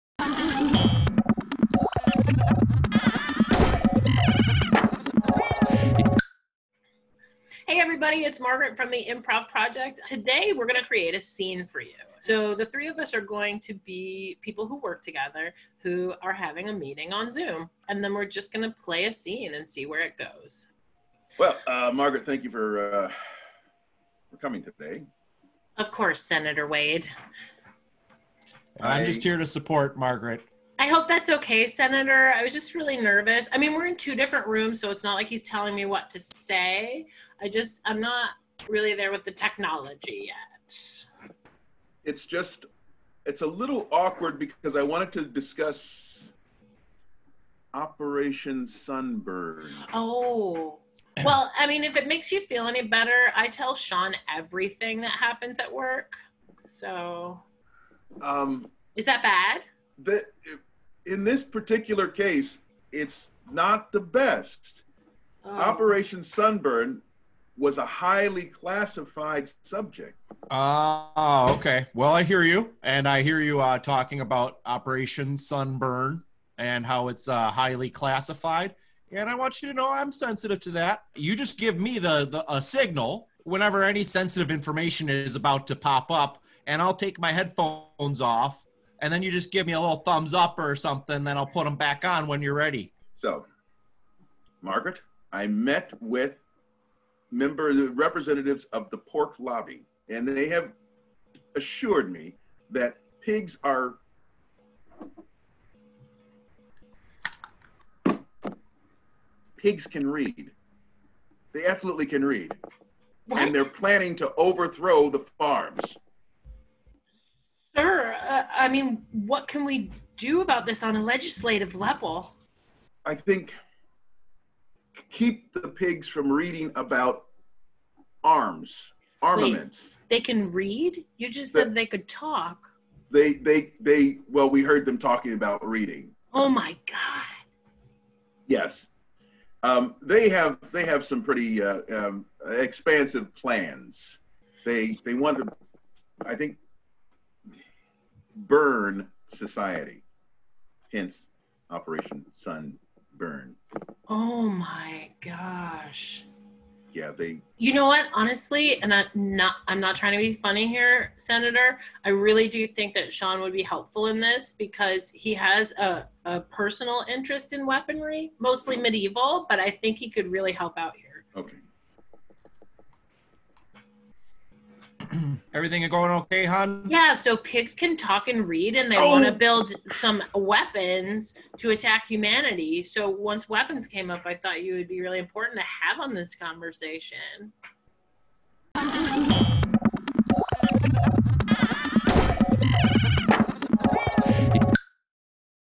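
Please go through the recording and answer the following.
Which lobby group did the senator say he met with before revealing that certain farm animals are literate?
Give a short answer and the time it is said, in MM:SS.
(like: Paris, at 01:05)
The pork lobby, at 01:38.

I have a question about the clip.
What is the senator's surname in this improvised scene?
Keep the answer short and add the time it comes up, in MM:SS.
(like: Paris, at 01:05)
Wade, at 00:26.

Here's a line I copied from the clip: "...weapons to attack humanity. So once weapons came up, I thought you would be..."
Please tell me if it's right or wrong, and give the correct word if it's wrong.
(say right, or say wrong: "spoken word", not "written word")
right.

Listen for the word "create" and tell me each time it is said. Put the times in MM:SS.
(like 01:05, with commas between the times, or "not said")
00:10.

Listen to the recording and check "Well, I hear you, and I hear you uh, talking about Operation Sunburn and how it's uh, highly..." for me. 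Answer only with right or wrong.
right.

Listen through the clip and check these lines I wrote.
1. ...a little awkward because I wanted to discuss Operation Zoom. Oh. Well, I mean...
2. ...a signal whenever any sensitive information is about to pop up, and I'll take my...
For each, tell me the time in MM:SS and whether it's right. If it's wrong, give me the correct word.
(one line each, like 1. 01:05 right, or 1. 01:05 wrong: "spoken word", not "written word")
1. 00:43 wrong: "Sunburn", not "Zoom"
2. 01:22 right.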